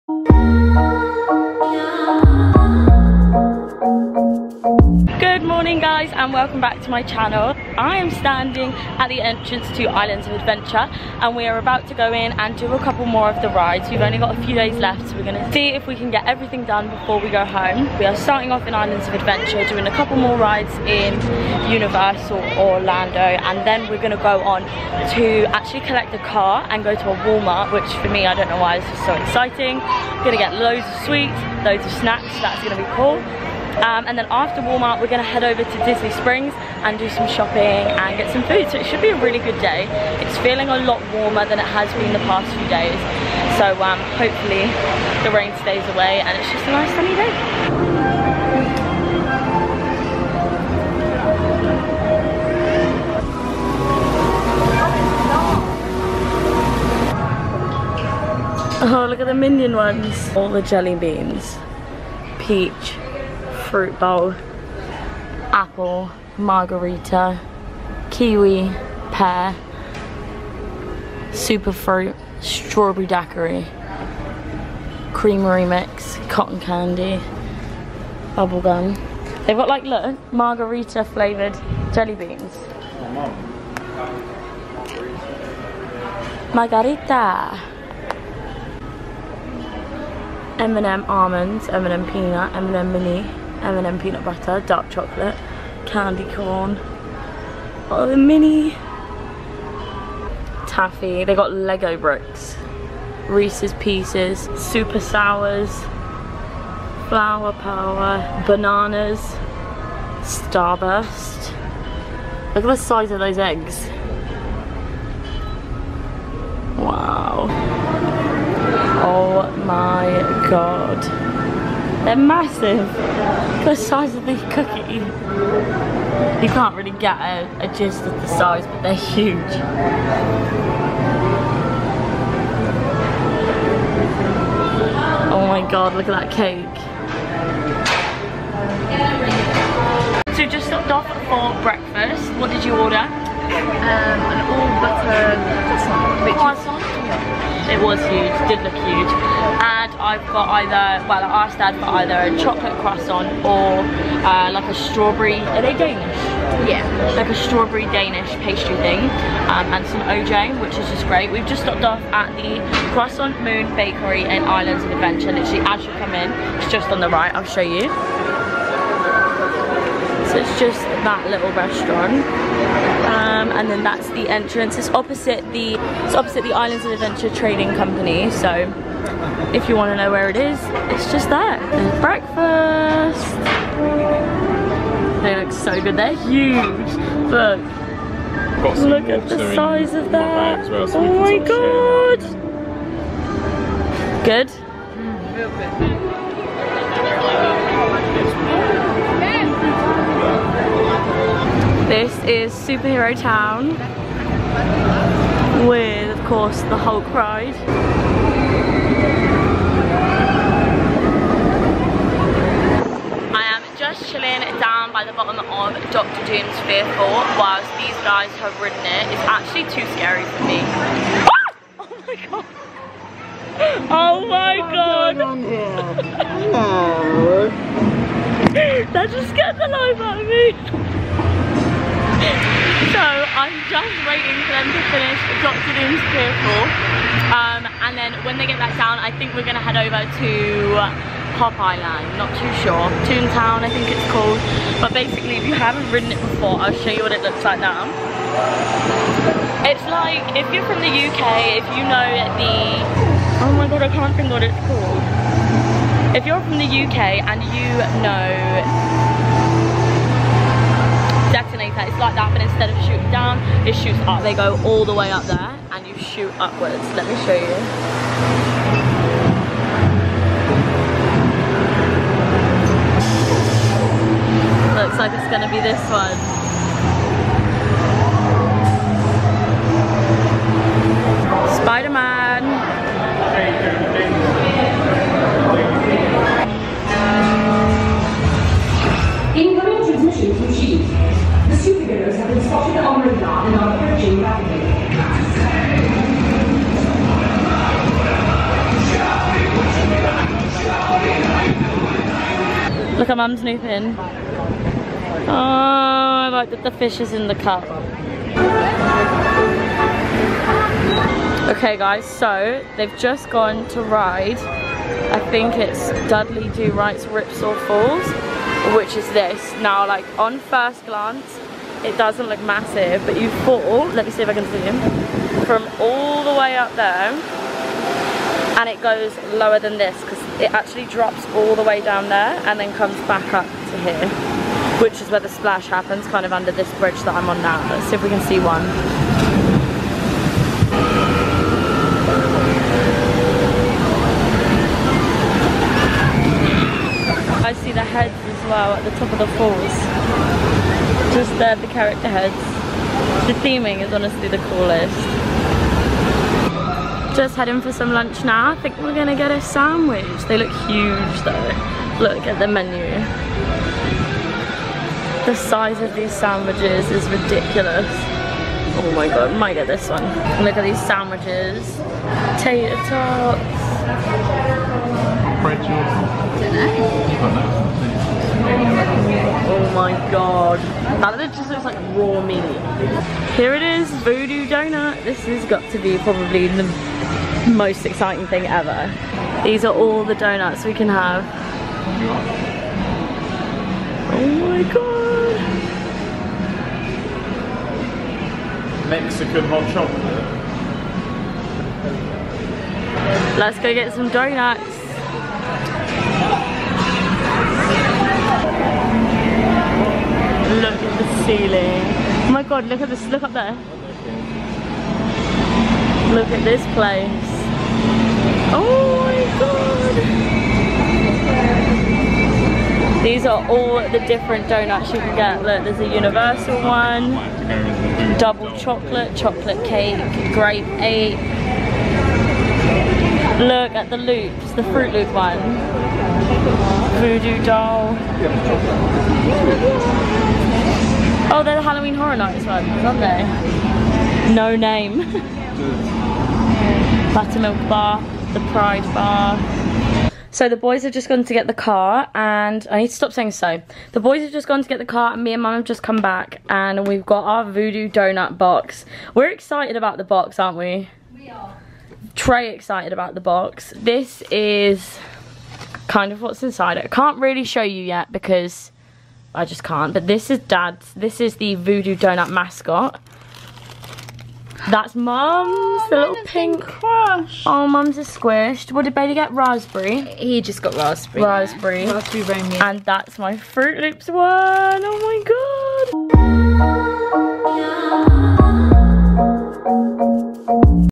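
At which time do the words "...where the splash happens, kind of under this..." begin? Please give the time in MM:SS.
05:35.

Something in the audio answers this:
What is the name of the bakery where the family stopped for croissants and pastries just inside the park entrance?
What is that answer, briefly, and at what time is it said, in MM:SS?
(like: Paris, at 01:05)
Croissant Moon Bakery, at 02:42.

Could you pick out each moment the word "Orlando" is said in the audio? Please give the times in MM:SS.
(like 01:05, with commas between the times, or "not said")
00:22.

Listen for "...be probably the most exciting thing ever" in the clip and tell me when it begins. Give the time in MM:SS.
06:25.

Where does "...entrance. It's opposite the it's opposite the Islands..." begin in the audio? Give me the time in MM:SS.
02:54.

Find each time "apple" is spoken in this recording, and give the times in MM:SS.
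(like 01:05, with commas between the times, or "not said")
01:05.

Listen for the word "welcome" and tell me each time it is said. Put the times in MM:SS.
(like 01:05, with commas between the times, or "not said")
00:06.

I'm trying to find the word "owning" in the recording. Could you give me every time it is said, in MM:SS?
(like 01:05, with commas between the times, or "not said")
not said.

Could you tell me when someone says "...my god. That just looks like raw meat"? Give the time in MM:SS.
06:19.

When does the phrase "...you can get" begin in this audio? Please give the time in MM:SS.
07:04.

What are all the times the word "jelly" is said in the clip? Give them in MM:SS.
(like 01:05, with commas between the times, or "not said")
01:00, 01:21.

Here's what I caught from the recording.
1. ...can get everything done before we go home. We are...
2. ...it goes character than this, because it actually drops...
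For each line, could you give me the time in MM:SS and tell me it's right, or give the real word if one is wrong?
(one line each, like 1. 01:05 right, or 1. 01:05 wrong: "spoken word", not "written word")
1. 00:15 right
2. 05:28 wrong: "lower", not "character".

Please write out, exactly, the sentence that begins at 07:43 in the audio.
This is kind of what's inside it.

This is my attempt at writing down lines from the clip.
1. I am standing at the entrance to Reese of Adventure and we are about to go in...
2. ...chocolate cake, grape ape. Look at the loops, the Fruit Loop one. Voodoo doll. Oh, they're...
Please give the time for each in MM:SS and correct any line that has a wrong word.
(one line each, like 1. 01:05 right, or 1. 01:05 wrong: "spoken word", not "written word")
1. 00:07 wrong: "Islands", not "Reese"
2. 07:09 right.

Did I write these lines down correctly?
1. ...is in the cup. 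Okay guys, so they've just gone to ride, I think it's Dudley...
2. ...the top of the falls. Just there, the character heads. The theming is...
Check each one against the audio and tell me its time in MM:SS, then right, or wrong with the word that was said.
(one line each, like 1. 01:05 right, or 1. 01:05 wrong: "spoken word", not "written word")
1. 05:06 right
2. 05:48 right.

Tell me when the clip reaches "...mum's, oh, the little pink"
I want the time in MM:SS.
07:54.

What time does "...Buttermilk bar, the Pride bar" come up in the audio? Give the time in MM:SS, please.
07:27.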